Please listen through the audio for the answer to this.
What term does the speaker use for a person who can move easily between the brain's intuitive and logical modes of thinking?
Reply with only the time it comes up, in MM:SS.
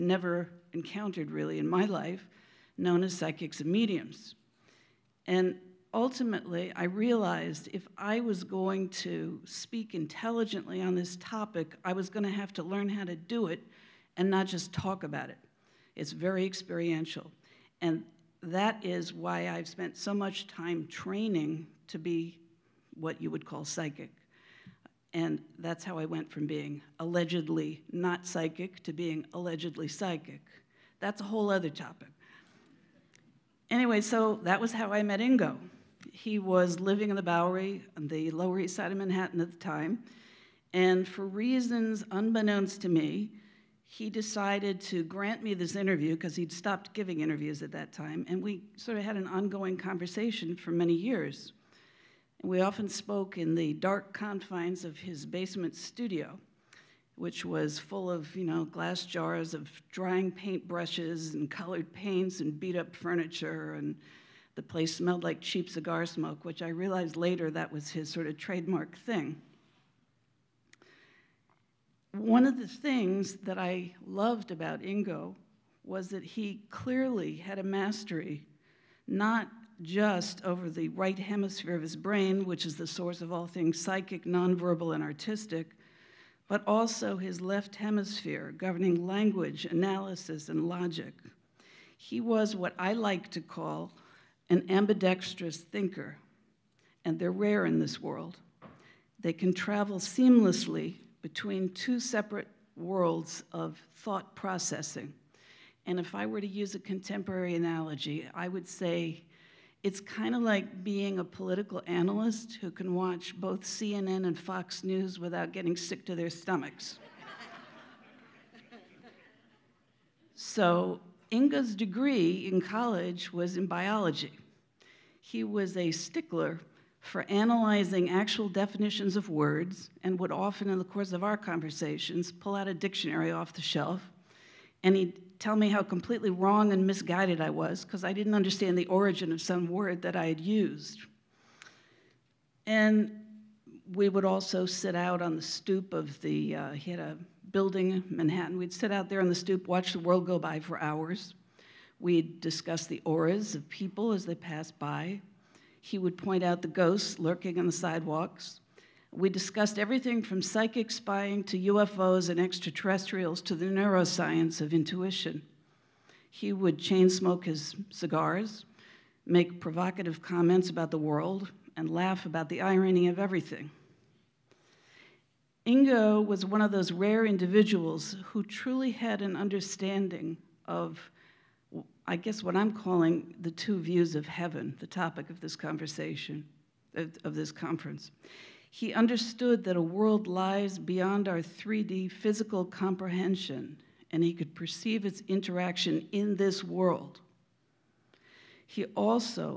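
01:34.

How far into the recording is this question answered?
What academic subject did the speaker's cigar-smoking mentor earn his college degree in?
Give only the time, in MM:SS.
02:03.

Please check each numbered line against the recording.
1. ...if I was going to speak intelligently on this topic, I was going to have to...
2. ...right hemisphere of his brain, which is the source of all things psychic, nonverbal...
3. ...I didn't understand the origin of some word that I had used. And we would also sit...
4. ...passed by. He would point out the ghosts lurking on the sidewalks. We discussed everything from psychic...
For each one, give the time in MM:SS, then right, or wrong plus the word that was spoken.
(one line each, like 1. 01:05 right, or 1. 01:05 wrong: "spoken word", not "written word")
1. 00:07 right
2. 01:20 right
3. 02:18 right
4. 02:34 right.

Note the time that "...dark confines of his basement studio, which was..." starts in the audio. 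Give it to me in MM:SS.
00:53.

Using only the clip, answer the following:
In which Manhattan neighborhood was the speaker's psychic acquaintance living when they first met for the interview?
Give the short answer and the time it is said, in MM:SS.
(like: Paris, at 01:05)
the Bowery, at 00:37.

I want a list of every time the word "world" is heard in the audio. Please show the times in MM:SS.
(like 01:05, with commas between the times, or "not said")
01:37, 01:42, 02:29, 02:50, 03:09, 03:16.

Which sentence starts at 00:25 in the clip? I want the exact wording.
And that's how I went from being allegedly not psychic to being allegedly psychic.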